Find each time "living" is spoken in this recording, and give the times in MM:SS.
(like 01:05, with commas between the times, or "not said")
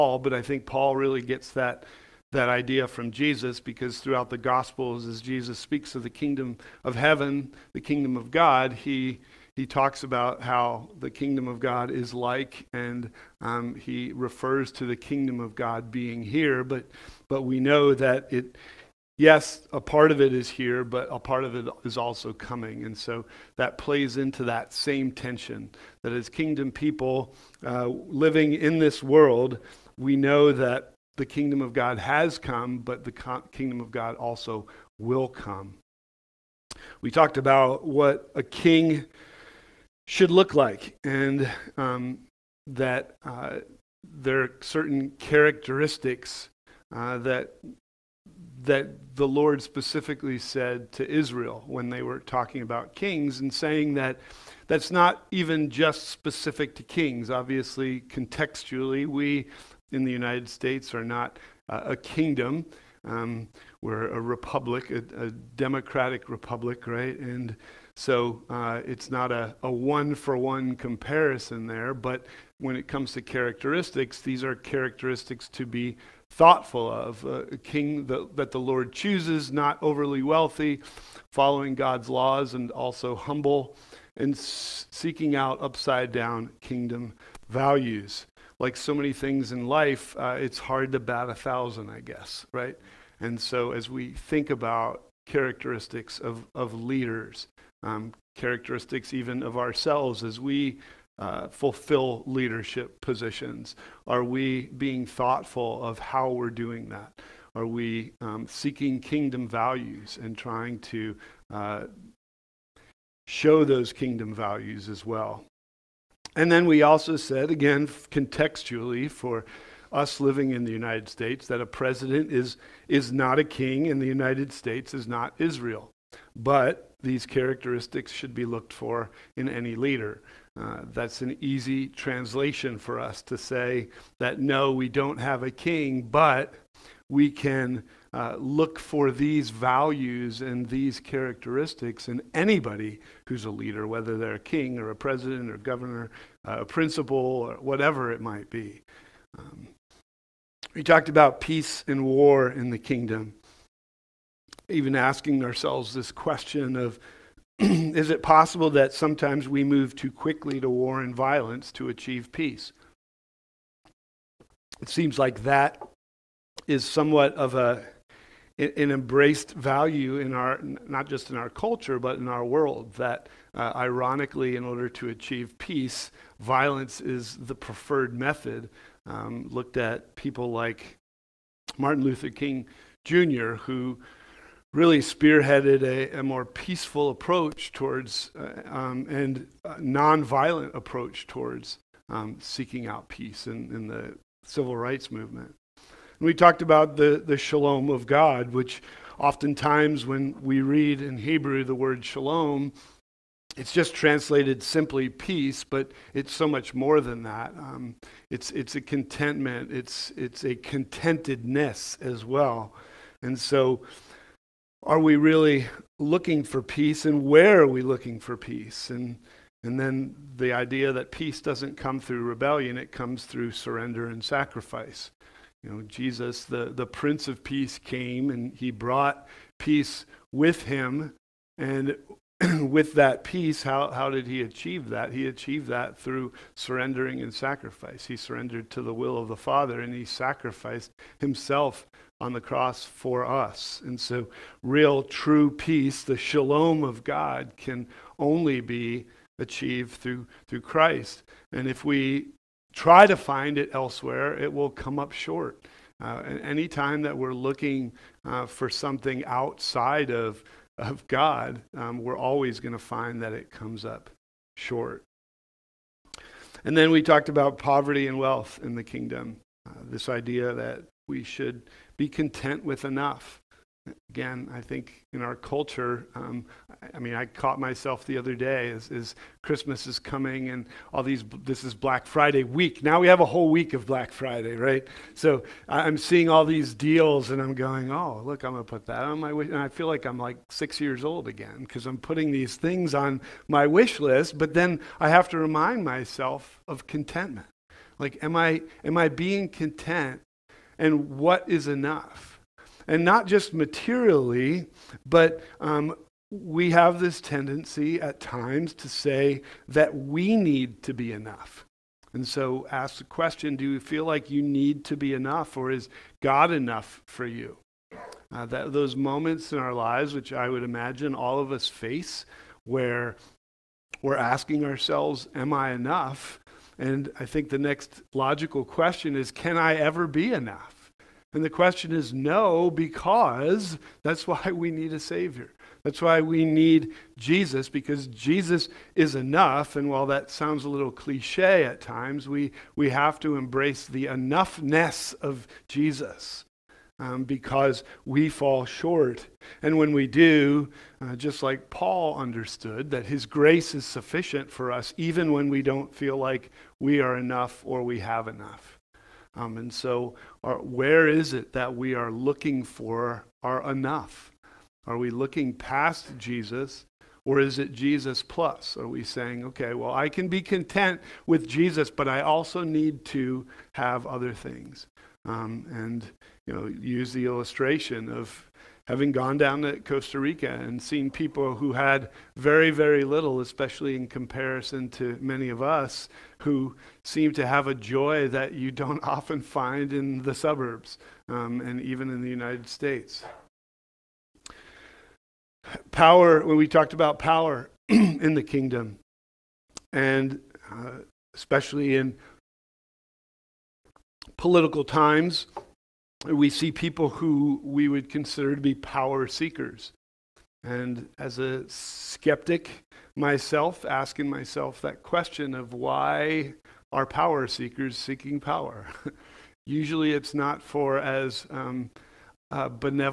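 00:27, 02:00.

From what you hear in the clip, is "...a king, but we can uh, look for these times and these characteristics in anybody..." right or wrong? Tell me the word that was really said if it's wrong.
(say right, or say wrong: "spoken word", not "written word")
wrong: "values", not "times".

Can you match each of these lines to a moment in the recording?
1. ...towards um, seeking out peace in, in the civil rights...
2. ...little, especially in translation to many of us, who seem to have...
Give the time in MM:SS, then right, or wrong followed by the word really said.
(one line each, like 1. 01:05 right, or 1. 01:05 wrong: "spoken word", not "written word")
1. 03:11 right
2. 06:23 wrong: "comparison", not "translation".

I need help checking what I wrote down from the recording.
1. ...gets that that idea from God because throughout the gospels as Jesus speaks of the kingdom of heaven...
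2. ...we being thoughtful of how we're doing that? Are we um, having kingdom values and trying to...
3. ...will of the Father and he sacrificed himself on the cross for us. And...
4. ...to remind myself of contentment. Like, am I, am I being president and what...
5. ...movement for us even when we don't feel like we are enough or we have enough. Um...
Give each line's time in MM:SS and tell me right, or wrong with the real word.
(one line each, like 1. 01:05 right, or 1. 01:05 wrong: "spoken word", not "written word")
1. 00:01 wrong: "Jesus", not "God"
2. 01:44 wrong: "seeking", not "having"
3. 03:58 right
4. 04:55 wrong: "content", not "president"
5. 05:53 wrong: "sufficient", not "movement".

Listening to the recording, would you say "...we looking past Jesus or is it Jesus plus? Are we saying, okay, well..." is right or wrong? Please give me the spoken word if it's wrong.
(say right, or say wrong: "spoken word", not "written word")
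right.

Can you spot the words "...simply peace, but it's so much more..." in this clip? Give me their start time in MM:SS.
03:24.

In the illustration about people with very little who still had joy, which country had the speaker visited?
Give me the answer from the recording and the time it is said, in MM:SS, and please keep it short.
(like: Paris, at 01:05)
Costa Rica, at 06:19.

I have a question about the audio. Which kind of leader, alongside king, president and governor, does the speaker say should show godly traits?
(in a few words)
principal.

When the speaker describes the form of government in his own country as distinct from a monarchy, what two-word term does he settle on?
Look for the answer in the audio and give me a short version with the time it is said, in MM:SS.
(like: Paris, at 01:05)
democratic republic, at 01:05.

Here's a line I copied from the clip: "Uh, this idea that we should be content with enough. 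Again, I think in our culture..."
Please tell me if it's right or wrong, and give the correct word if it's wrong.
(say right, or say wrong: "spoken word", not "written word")
right.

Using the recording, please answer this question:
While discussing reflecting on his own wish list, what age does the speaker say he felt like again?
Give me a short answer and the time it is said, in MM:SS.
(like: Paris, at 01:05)
6, at 04:50.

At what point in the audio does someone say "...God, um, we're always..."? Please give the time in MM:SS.
04:21.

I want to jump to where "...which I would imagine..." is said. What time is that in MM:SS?
05:20.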